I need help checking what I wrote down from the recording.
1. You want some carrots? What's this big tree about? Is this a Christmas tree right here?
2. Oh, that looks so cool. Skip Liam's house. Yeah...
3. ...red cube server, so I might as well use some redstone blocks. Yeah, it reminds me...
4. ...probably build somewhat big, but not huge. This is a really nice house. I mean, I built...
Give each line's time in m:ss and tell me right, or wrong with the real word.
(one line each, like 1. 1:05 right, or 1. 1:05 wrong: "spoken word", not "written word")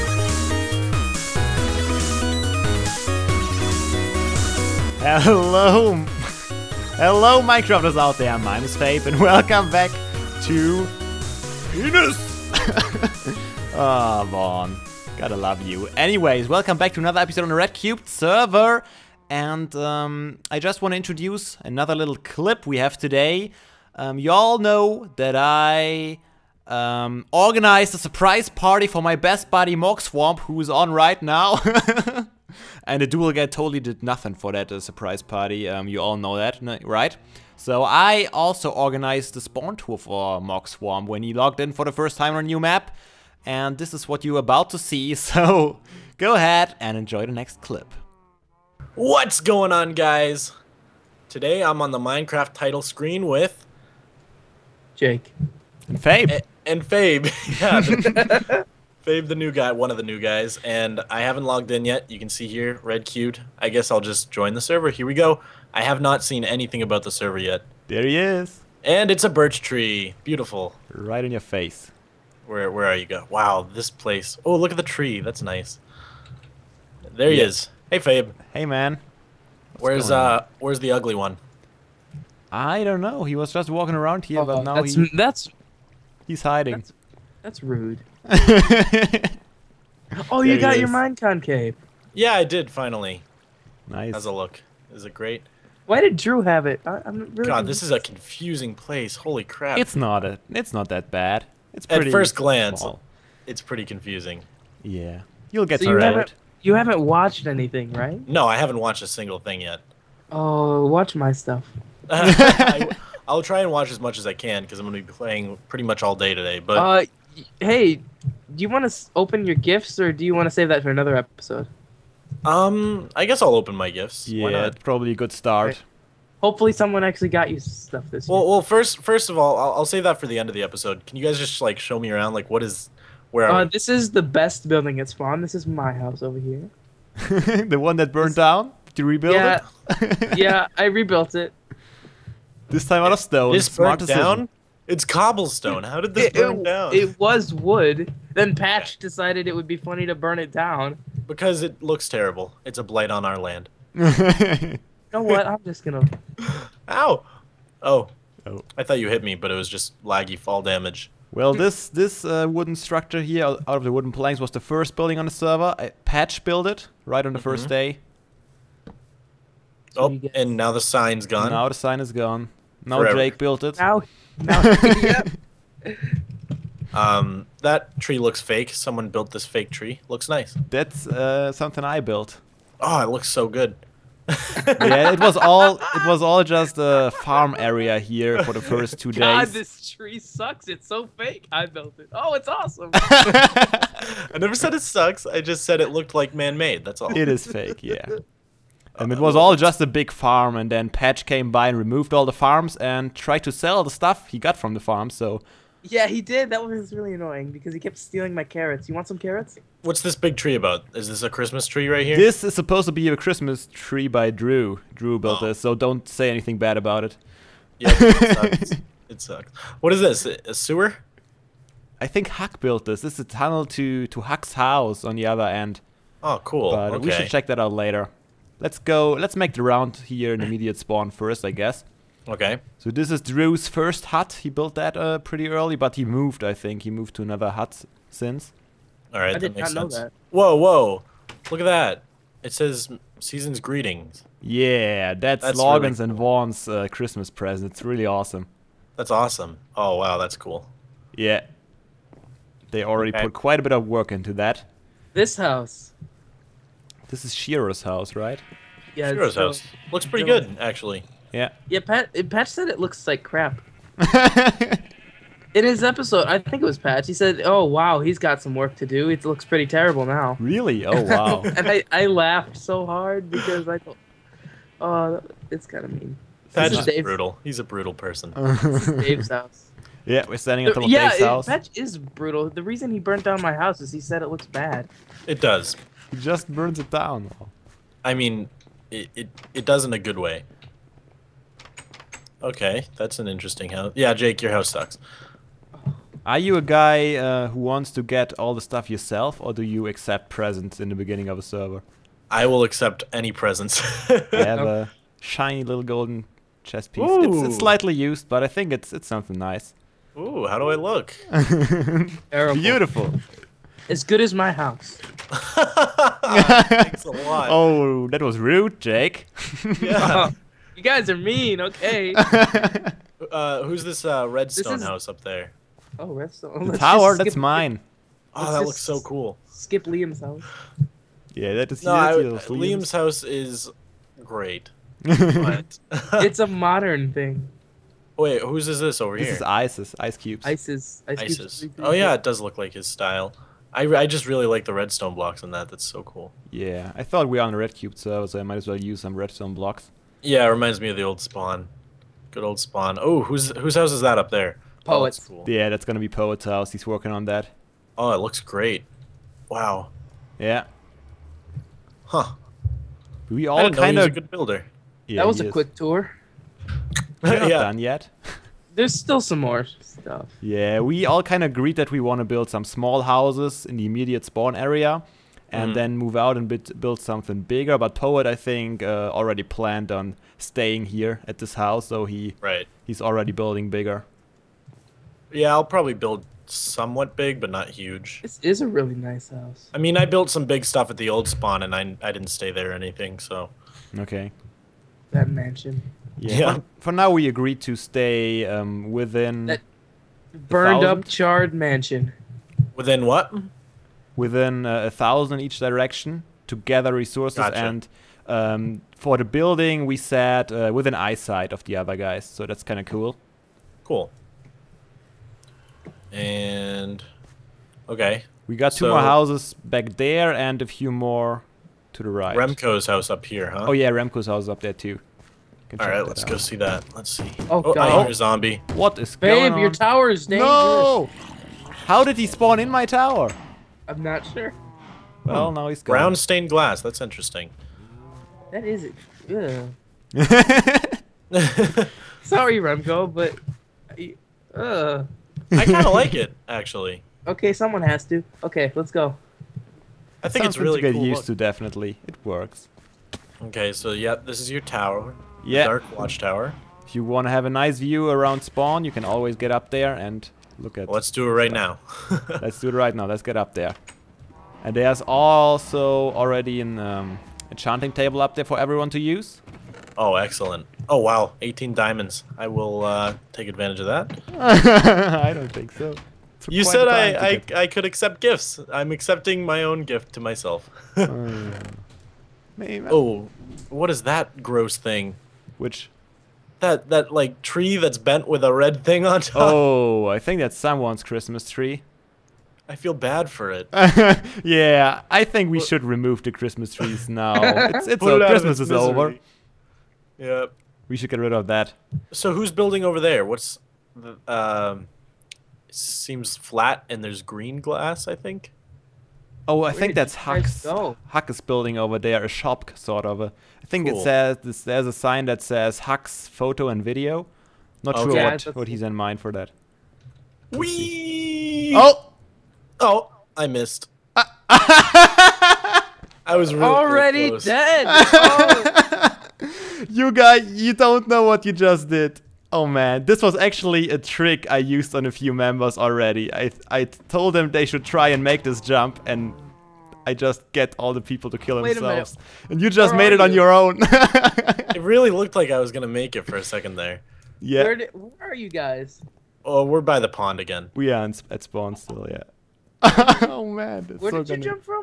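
1. 3:28 right
2. 5:28 right
3. 5:47 right
4. 6:25 right.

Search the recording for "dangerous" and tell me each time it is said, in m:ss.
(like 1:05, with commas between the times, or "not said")
7:10.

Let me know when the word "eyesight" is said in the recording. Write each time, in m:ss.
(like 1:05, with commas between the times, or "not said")
6:50.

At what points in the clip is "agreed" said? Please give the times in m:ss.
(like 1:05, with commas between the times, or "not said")
6:11, 6:37.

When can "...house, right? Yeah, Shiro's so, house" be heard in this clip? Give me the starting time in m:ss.
4:17.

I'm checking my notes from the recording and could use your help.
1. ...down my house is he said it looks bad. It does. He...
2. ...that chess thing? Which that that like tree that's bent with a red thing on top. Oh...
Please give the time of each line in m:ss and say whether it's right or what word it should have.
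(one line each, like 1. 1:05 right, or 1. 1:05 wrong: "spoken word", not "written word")
1. 4:43 right
2. 8:04 wrong: "gross", not "chess".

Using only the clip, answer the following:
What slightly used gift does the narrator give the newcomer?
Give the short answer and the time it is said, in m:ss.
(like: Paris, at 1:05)
Golden chess piece, at 5:05.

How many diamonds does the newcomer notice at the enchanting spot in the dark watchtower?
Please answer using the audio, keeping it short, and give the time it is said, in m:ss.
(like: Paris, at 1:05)
18, at 7:51.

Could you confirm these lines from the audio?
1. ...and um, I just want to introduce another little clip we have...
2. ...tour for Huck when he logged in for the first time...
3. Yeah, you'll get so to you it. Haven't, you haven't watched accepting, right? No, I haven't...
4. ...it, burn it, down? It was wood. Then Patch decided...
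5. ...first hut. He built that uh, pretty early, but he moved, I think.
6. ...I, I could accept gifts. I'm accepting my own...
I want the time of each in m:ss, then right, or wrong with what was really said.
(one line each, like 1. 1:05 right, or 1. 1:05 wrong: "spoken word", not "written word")
1. 0:19 right
2. 0:39 wrong: "Mogswamp", not "Huck"
3. 1:44 wrong: "anything", not "accepting"
4. 2:26 right
5. 3:53 right
6. 7:57 right.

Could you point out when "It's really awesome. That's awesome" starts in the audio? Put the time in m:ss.
4:07.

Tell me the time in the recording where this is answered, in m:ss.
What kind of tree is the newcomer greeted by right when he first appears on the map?
1:09.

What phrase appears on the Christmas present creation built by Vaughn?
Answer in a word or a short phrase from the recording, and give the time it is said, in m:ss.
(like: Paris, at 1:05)
Season's Greetings, at 4:03.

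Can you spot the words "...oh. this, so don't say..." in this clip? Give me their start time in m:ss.
3:35.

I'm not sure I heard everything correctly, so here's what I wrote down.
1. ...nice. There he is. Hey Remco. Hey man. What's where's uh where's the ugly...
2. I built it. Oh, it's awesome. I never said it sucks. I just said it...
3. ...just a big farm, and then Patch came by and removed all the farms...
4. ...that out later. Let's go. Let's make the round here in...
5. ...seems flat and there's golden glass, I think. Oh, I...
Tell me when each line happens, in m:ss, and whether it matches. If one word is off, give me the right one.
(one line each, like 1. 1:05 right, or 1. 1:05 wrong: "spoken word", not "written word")
1. 1:15 wrong: "Fabe", not "Remco"
2. 3:11 right
3. 3:19 right
4. 3:47 right
5. 8:25 wrong: "green", not "golden".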